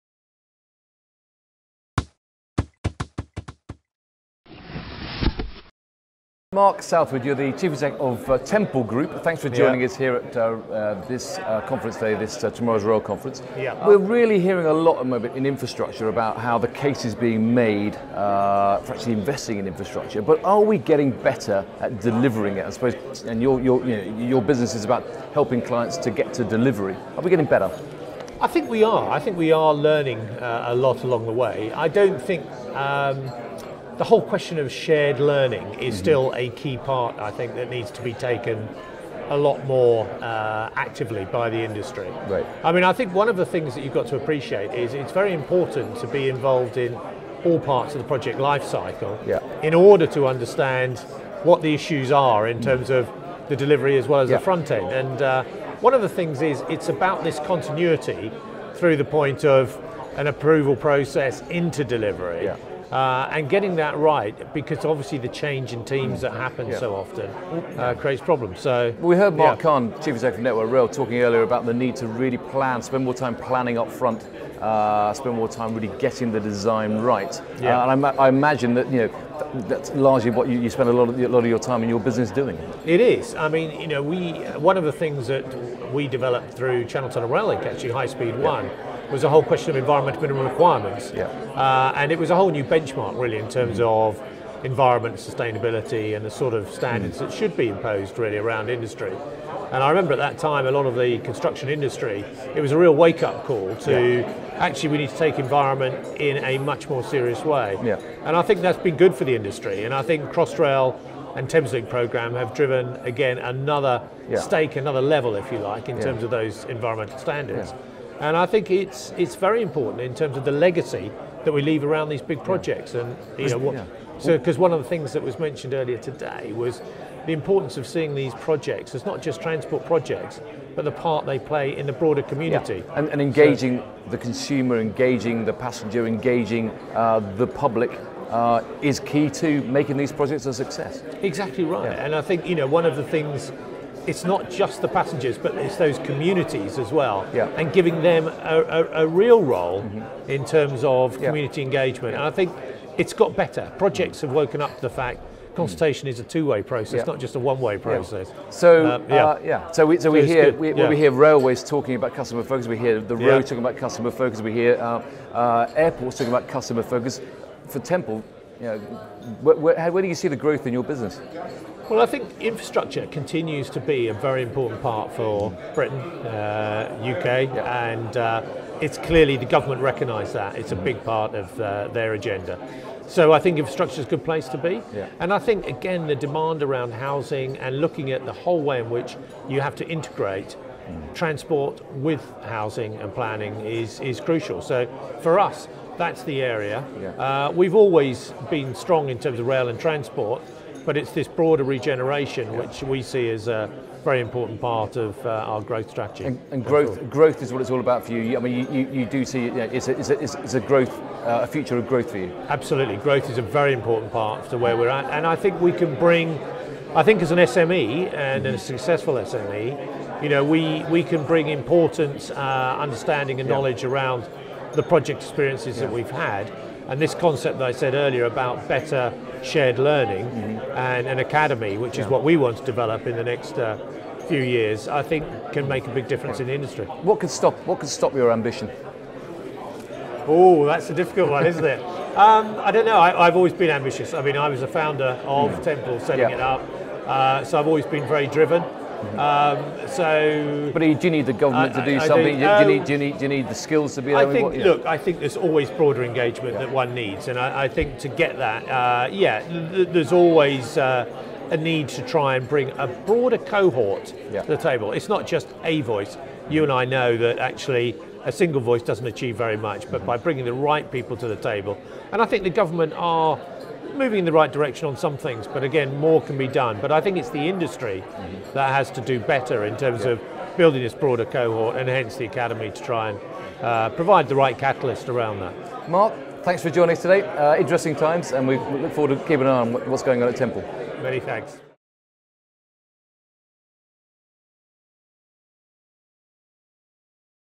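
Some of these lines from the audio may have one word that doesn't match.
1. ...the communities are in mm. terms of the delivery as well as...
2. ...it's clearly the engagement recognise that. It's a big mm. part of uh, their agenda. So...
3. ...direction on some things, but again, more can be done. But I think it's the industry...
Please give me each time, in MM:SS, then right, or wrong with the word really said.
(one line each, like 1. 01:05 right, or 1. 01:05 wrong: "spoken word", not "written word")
1. 00:51 wrong: "issues", not "communities"
2. 02:58 wrong: "government", not "engagement"
3. 04:34 right.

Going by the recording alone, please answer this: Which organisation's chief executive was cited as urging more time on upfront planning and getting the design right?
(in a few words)
Network Rail.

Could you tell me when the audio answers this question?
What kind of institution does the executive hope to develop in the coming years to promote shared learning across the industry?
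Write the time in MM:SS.
03:51.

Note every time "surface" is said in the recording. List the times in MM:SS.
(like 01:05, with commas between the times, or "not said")
not said.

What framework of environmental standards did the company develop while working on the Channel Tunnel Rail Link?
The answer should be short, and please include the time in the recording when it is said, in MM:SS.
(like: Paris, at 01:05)
environmental minimum requirements, at 01:29.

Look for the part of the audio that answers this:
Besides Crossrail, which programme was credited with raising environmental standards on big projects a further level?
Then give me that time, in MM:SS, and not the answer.
01:51.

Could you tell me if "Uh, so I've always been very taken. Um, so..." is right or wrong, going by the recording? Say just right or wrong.
wrong.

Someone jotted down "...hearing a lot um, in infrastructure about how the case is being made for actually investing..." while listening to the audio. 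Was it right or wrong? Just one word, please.
right.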